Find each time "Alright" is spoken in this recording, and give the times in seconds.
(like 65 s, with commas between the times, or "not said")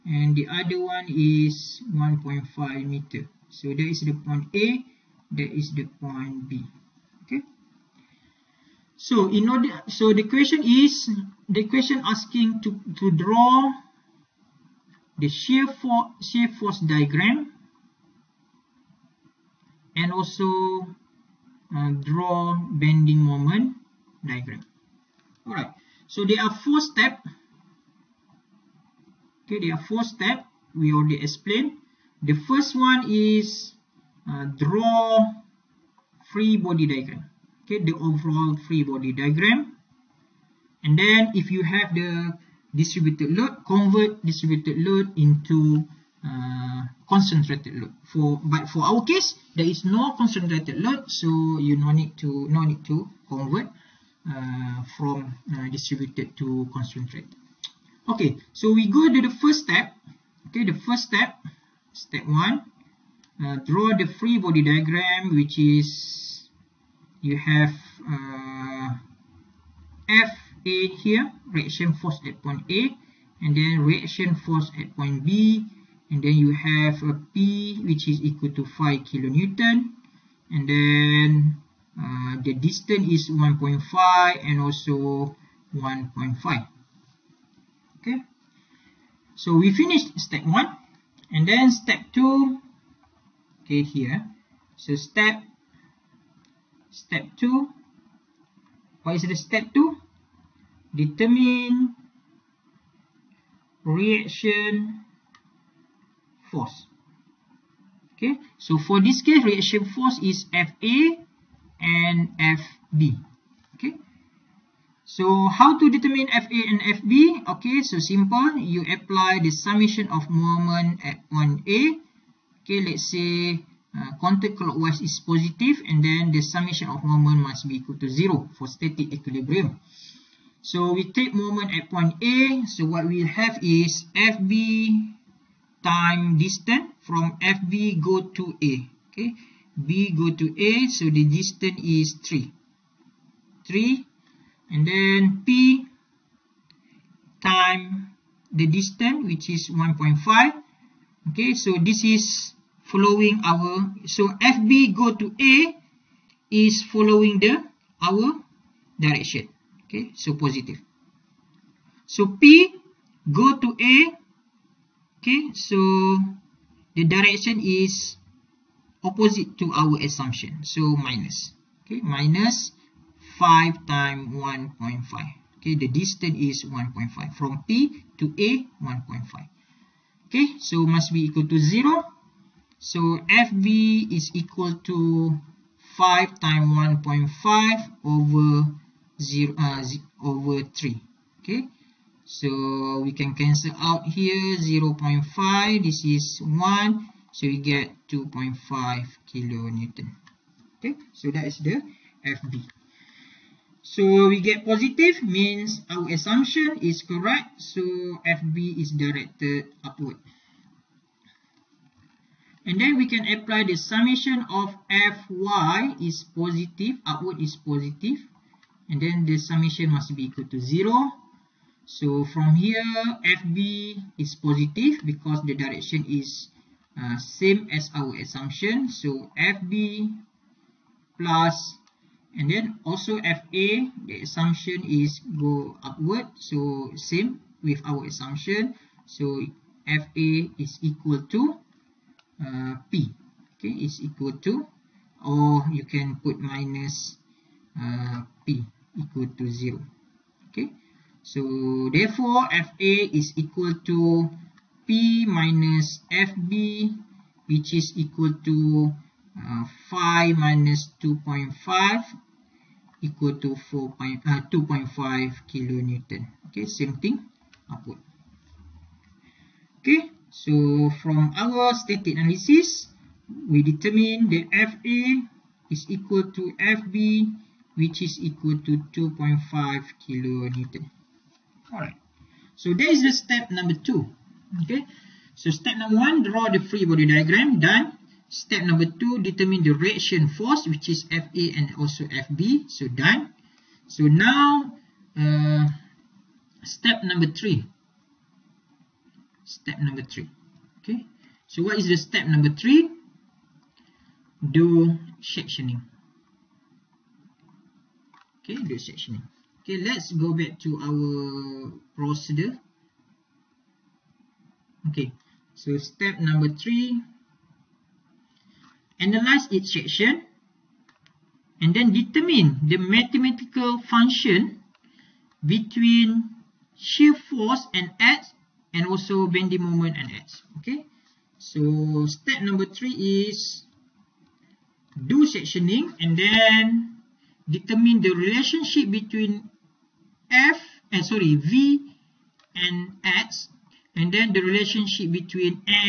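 25 s, 281 s.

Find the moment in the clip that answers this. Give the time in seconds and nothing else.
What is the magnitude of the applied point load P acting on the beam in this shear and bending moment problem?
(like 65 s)
77 s.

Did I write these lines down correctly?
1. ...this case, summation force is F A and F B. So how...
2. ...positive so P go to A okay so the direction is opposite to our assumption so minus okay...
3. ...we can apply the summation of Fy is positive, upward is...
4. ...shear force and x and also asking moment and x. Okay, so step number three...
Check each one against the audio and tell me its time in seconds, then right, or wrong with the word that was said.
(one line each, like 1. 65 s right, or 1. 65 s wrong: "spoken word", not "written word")
1. 109 s wrong: "reaction", not "summation"
2. 160 s right
3. 213 s right
4. 326 s wrong: "bending", not "asking".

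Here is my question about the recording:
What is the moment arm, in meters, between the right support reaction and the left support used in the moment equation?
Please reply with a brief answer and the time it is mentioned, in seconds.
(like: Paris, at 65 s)
3, at 140 s.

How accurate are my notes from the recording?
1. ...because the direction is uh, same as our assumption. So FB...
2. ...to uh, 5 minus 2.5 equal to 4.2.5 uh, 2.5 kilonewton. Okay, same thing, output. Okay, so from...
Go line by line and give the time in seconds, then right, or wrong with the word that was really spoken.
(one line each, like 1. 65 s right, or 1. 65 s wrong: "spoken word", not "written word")
1. 225 s right
2. 258 s right.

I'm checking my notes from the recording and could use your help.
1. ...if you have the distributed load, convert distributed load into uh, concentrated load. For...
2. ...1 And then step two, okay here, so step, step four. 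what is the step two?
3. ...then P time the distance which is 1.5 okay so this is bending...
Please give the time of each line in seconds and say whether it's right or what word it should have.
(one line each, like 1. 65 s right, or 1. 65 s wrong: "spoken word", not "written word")
1. 41 s right
2. 90 s wrong: "two", not "four"
3. 144 s wrong: "following", not "bending".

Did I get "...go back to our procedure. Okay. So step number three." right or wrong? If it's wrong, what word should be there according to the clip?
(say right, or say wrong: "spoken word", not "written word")
right.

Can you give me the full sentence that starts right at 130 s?
So we take moment at point A.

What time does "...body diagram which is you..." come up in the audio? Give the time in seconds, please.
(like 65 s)
64 s.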